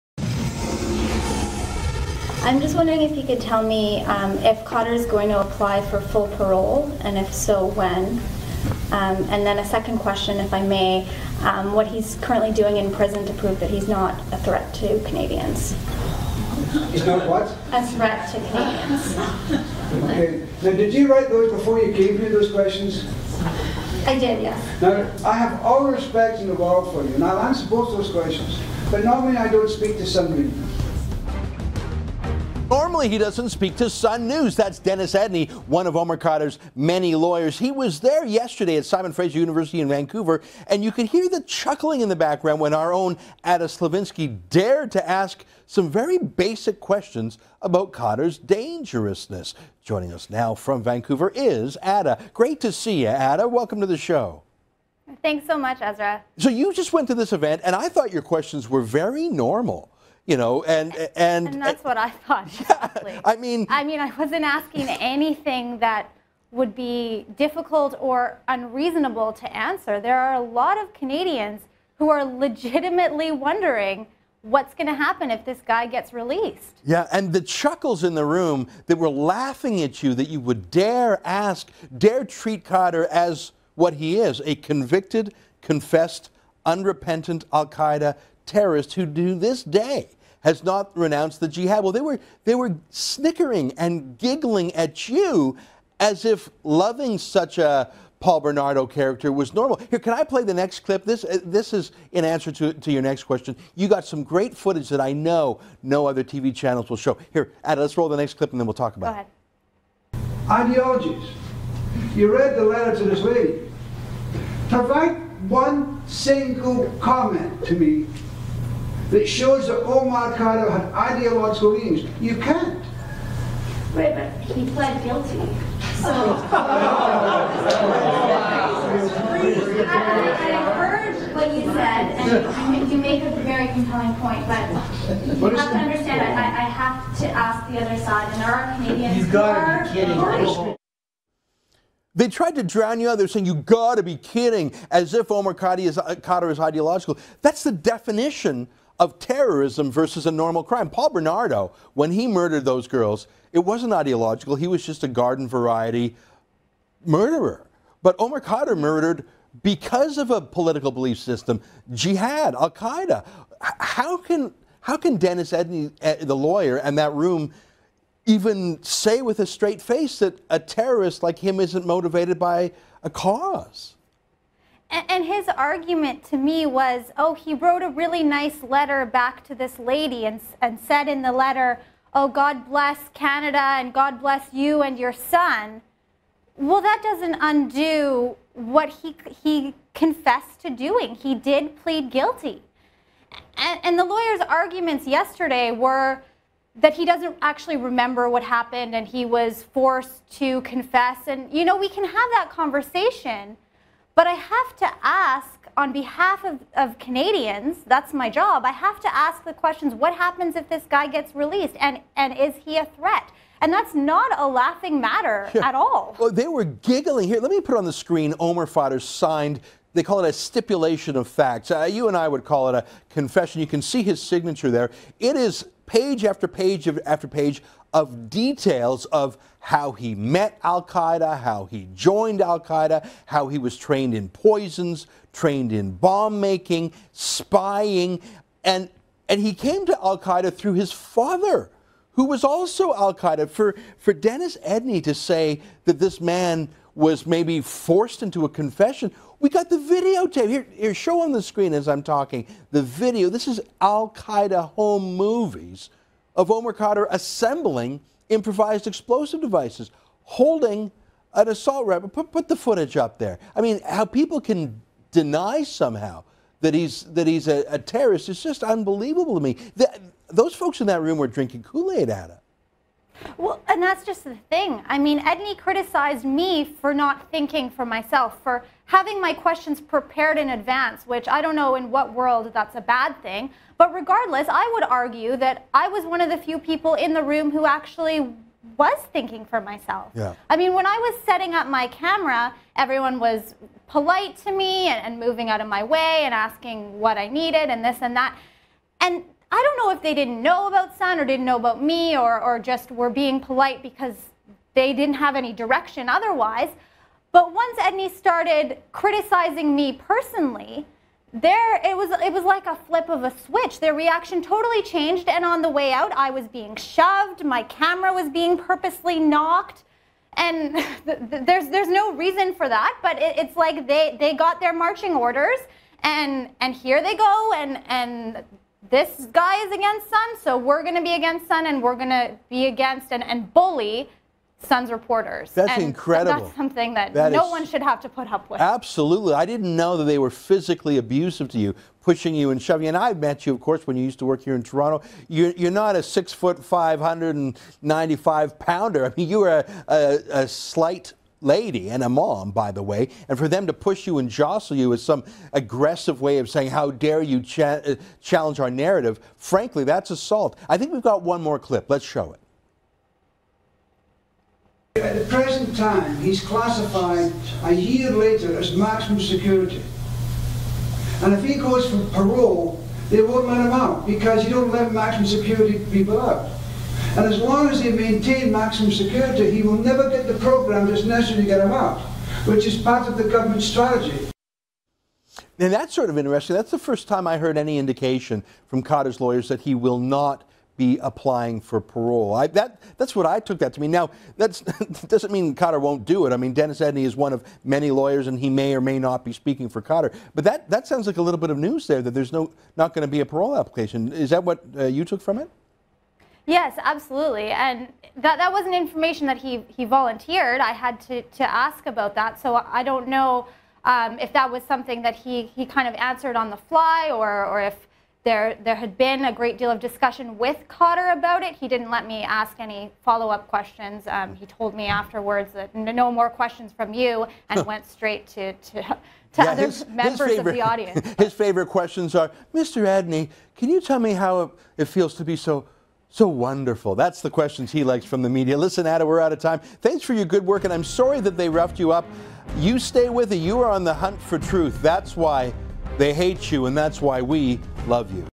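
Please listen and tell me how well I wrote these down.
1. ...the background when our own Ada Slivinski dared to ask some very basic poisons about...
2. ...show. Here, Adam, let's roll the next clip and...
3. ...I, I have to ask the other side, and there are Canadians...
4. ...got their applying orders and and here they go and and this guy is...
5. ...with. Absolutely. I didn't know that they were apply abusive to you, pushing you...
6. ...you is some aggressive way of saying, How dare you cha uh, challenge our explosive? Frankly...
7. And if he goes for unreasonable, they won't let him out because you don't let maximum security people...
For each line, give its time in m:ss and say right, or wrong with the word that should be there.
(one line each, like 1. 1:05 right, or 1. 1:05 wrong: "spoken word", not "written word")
1. 0:42 wrong: "questions", not "poisons"
2. 1:46 right
3. 2:16 right
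4. 5:24 wrong: "marching", not "applying"
5. 5:38 wrong: "physically", not "apply"
6. 5:54 wrong: "narrative", not "explosive"
7. 6:11 wrong: "parole", not "unreasonable".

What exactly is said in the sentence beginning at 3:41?
Uh, you and I would call it a confession.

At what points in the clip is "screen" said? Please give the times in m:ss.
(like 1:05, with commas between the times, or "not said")
3:37, 4:11.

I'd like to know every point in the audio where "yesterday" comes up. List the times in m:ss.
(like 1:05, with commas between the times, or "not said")
0:38, 3:15.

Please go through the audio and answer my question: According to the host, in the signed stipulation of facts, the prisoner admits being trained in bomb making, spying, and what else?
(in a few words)
poisons.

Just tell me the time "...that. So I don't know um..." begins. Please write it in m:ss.
6:52.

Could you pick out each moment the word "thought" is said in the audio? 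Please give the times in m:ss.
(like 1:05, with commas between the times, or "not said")
0:57, 1:02.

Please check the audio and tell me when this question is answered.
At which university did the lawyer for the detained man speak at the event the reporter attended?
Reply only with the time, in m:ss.
0:38.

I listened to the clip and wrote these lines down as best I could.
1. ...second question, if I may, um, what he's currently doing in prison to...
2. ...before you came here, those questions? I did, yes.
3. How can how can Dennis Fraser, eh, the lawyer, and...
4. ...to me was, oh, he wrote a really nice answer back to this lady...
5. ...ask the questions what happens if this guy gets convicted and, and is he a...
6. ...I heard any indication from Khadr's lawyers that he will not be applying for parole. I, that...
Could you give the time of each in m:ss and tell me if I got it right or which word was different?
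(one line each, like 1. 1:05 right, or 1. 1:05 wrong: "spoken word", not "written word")
1. 0:09 right
2. 0:21 right
3. 2:43 wrong: "Edney", not "Fraser"
4. 2:56 wrong: "letter", not "answer"
5. 3:29 wrong: "released", not "convicted"
6. 6:27 right.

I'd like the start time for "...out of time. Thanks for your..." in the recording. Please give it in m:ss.
7:19.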